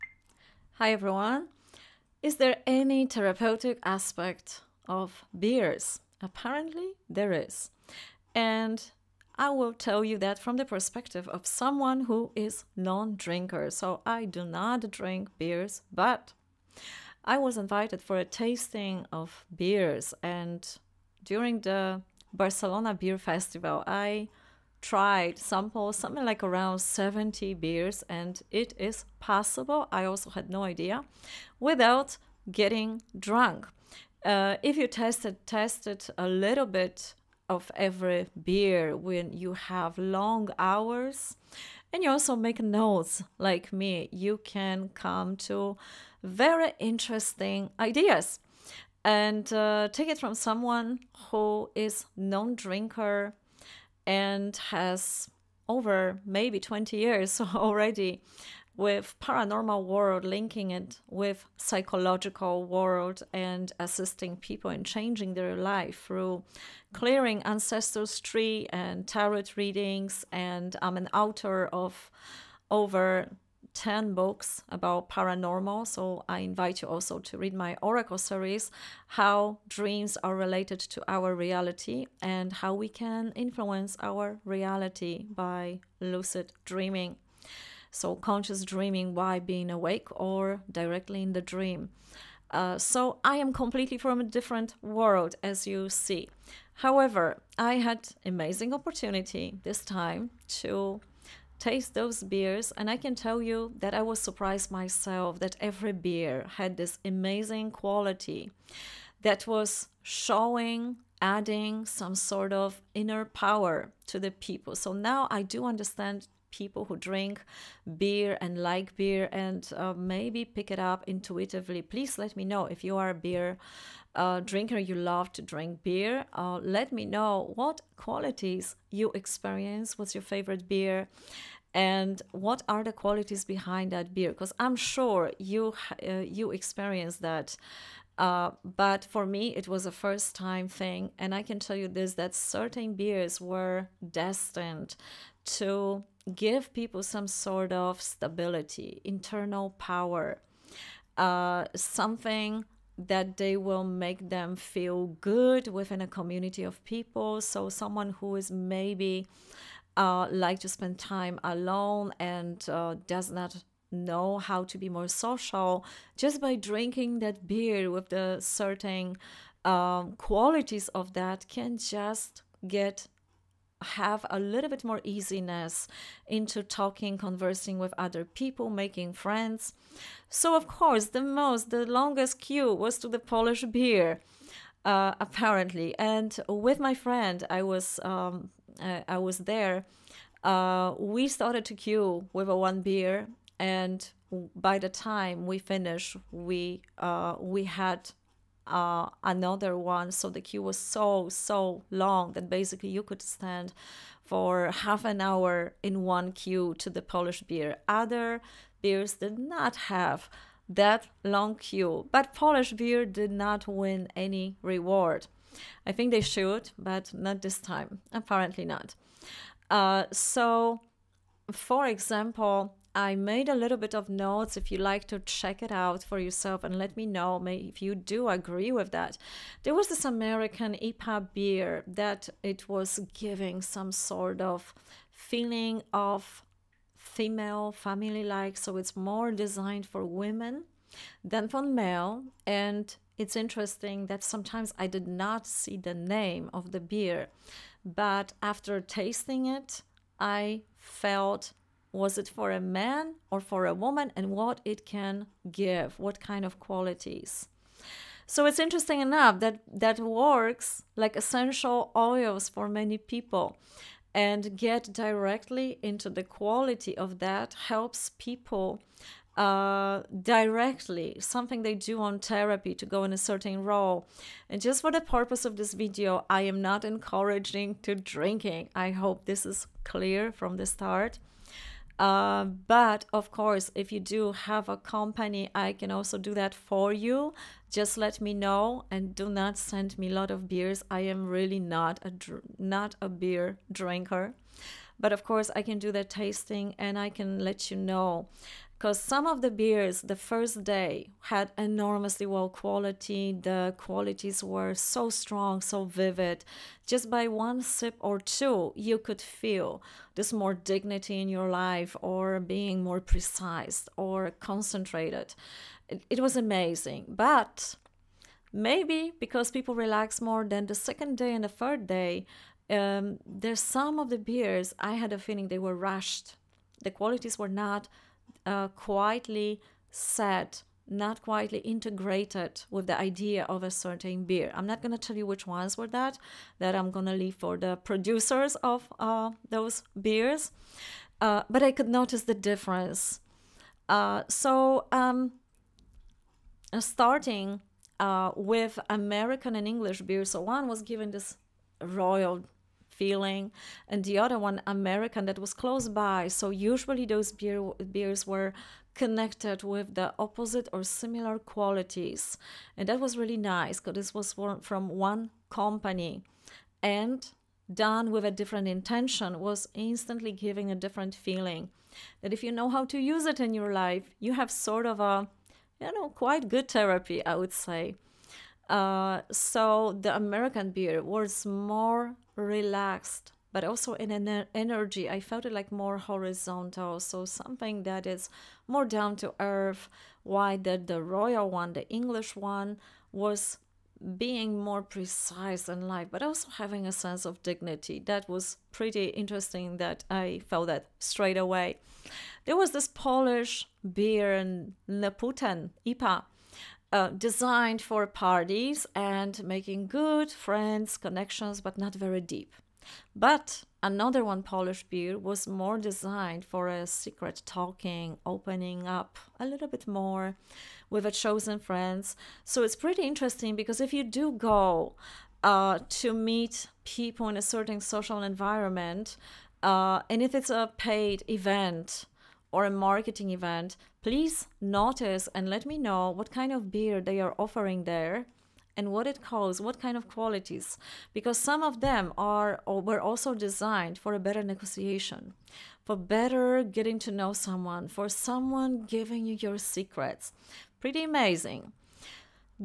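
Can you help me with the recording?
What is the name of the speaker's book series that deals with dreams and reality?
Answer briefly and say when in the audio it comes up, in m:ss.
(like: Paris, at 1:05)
Oracle, at 1:17.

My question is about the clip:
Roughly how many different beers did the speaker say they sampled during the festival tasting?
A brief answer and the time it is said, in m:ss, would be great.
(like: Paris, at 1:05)
70, at 0:26.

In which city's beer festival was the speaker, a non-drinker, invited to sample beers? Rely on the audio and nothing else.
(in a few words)
Barcelona.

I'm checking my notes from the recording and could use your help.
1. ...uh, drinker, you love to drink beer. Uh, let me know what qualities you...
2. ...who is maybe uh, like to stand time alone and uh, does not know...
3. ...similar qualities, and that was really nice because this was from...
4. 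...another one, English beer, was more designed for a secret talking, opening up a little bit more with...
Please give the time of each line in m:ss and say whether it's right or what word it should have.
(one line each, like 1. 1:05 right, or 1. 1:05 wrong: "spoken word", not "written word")
1. 2:04 right
2. 2:38 wrong: "spend", not "stand"
3. 6:00 right
4. 6:53 wrong: "Polish", not "English".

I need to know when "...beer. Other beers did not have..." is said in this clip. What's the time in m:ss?
3:27.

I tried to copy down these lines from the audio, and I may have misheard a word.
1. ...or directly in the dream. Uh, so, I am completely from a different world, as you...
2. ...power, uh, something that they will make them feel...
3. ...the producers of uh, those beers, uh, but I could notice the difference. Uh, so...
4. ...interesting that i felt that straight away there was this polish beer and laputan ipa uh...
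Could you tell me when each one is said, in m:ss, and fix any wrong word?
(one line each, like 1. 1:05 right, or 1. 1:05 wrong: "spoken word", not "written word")
1. 1:30 right
2. 2:29 right
3. 5:37 right
4. 6:39 right.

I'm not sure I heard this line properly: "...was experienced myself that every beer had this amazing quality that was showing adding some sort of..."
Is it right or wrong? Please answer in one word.
wrong.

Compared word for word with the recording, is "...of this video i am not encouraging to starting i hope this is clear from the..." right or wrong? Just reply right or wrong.
wrong.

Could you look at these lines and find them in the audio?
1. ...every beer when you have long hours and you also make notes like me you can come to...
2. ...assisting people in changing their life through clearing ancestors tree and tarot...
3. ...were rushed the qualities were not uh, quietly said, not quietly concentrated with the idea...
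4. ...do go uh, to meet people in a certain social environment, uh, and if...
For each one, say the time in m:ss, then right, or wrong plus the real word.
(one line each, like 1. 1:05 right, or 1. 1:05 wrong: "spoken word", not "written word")
1. 0:37 right
2. 1:03 right
3. 5:25 wrong: "integrated", not "concentrated"
4. 7:04 right.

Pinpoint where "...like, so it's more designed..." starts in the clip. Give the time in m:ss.
3:58.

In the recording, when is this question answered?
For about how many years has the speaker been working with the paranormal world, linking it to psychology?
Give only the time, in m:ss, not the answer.
0:56.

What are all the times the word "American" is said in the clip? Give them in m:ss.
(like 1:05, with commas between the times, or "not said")
3:50, 5:48, 5:54, 6:20.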